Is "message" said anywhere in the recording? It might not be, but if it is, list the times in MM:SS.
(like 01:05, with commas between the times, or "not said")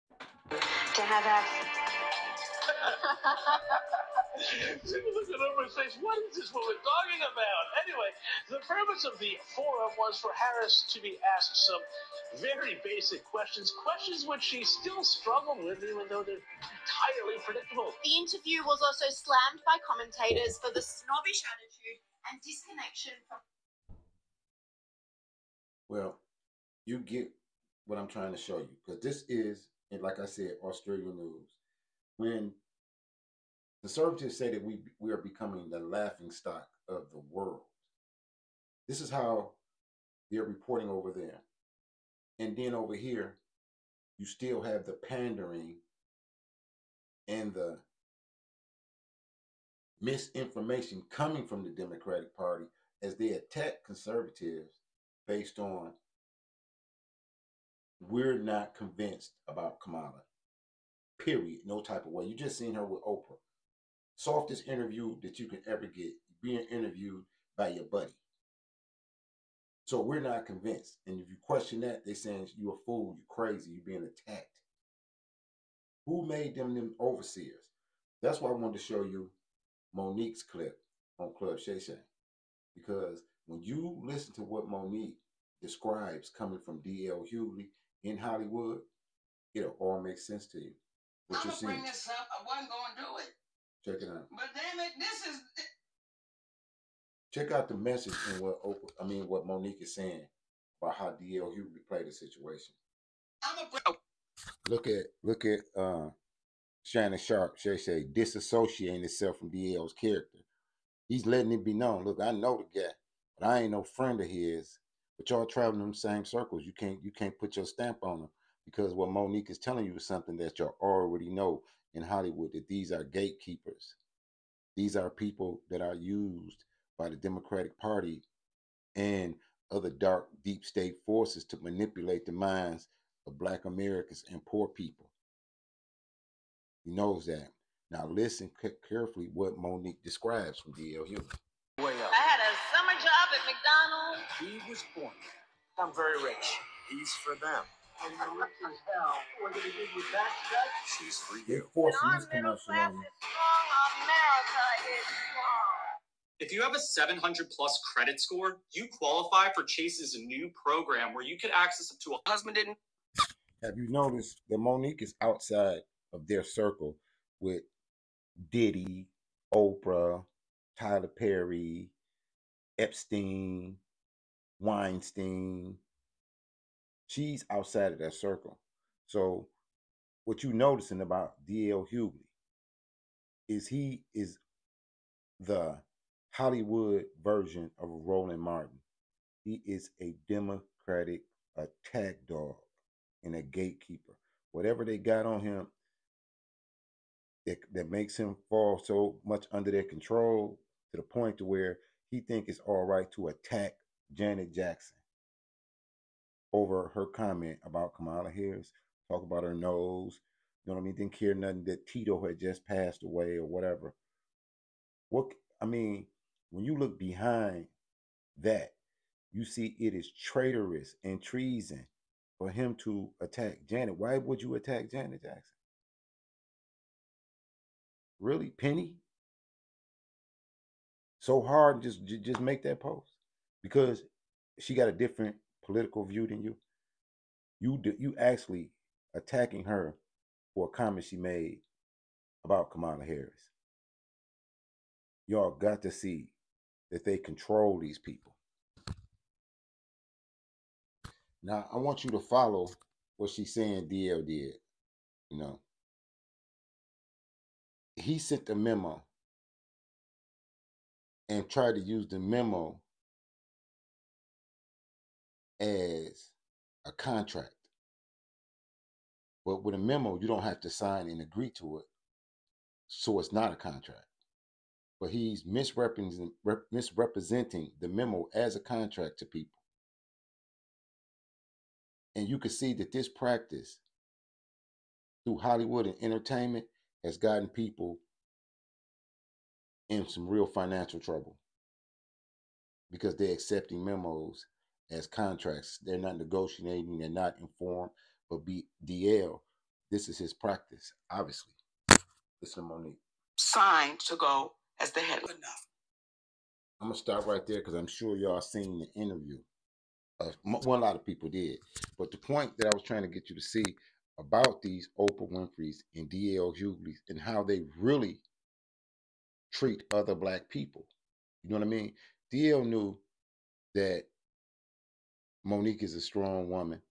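01:37.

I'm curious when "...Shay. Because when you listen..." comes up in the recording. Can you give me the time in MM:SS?
01:21.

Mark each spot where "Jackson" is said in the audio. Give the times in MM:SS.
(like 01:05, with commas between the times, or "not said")
03:24, 03:45.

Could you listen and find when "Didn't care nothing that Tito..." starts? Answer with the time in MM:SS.
03:30.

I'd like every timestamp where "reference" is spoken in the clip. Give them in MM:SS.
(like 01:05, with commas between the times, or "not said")
not said.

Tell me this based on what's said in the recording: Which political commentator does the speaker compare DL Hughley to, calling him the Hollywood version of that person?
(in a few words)
Roland Martin.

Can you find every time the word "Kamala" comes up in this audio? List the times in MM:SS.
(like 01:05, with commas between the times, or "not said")
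00:59, 03:27, 04:02.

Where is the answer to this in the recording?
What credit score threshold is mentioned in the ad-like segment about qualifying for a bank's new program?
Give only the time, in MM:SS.
02:36.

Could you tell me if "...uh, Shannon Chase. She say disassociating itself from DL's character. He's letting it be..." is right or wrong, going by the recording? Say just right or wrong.
wrong.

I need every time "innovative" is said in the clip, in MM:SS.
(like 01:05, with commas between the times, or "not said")
not said.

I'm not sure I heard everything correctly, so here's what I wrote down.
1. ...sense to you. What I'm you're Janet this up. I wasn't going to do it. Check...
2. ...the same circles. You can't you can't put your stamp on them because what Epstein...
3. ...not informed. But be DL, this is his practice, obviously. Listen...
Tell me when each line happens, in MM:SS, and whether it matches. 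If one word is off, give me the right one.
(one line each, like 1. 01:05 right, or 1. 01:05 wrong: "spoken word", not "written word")
1. 01:30 wrong: "Bring", not "Janet"
2. 01:55 wrong: "Monique", not "Epstein"
3. 04:57 right.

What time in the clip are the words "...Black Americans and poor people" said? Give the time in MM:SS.
02:13.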